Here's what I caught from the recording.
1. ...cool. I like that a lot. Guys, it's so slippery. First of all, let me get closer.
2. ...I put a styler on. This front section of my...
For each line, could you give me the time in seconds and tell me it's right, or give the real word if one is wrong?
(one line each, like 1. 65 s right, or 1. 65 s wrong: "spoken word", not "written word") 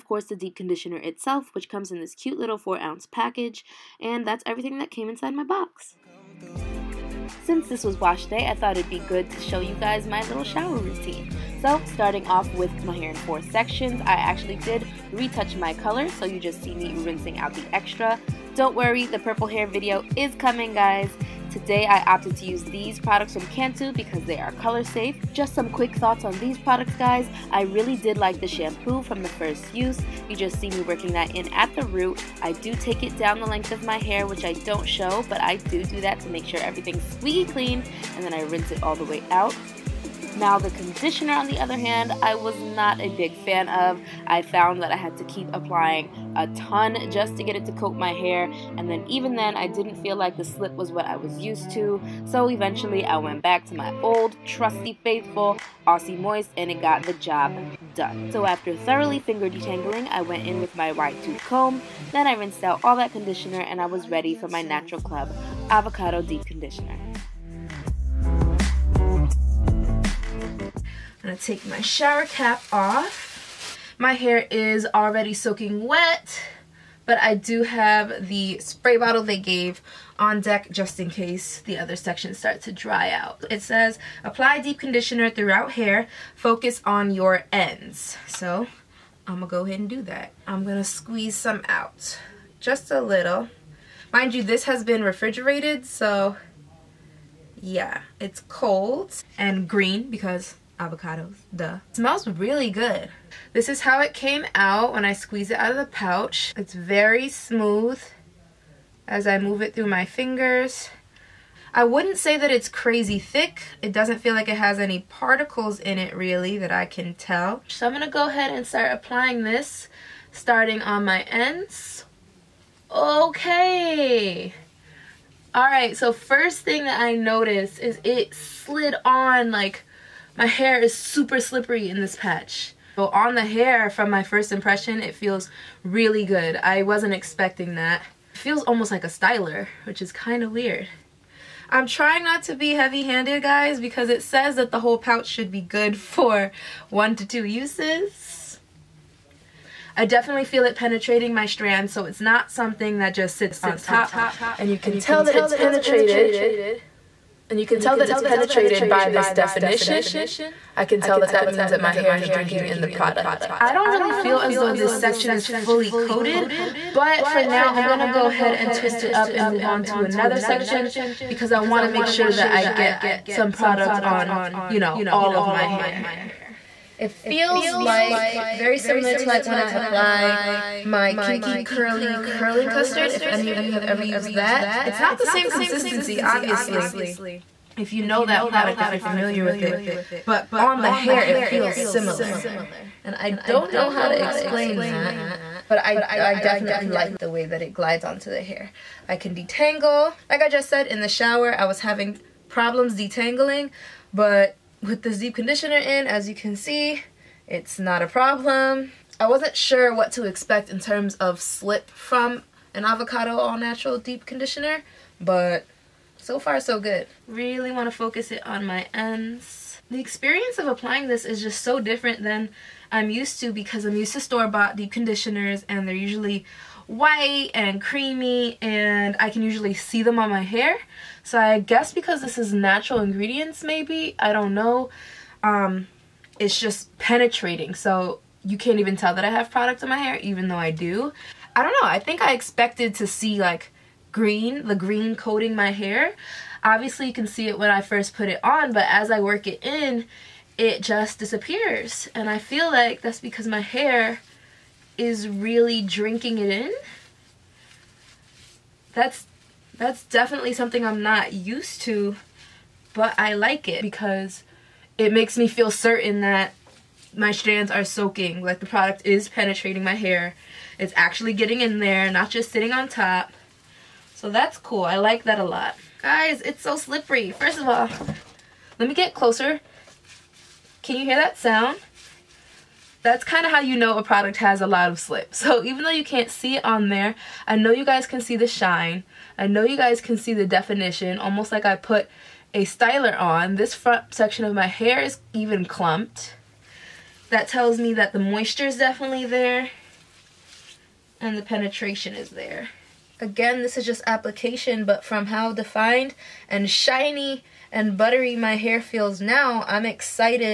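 1. 274 s right
2. 291 s right.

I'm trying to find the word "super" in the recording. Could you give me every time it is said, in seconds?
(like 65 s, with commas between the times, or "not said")
130 s.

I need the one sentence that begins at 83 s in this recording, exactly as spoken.
It says, apply deep conditioner throughout hair, focus on your ends.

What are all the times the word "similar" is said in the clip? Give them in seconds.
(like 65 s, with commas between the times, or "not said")
178 s, 191 s.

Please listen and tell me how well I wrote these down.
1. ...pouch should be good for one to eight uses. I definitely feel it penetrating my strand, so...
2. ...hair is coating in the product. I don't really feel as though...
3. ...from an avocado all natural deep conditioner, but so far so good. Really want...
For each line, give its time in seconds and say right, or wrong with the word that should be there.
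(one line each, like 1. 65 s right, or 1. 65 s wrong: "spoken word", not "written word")
1. 144 s wrong: "two", not "eight"
2. 161 s wrong: "drinking", not "coating"
3. 211 s right.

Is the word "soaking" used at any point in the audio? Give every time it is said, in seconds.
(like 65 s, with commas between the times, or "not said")
75 s, 267 s.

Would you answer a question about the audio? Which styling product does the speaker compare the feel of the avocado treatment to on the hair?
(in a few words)
Kinky Curly Curling Custard.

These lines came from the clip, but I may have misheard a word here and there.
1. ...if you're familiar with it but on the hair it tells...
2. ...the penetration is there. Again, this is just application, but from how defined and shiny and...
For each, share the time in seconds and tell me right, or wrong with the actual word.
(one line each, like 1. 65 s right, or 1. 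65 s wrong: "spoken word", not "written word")
1. 188 s wrong: "feels", not "tells"
2. 301 s right.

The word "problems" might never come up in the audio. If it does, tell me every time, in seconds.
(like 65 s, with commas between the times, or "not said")
202 s, 208 s.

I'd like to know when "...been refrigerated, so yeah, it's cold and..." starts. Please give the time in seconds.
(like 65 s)
94 s.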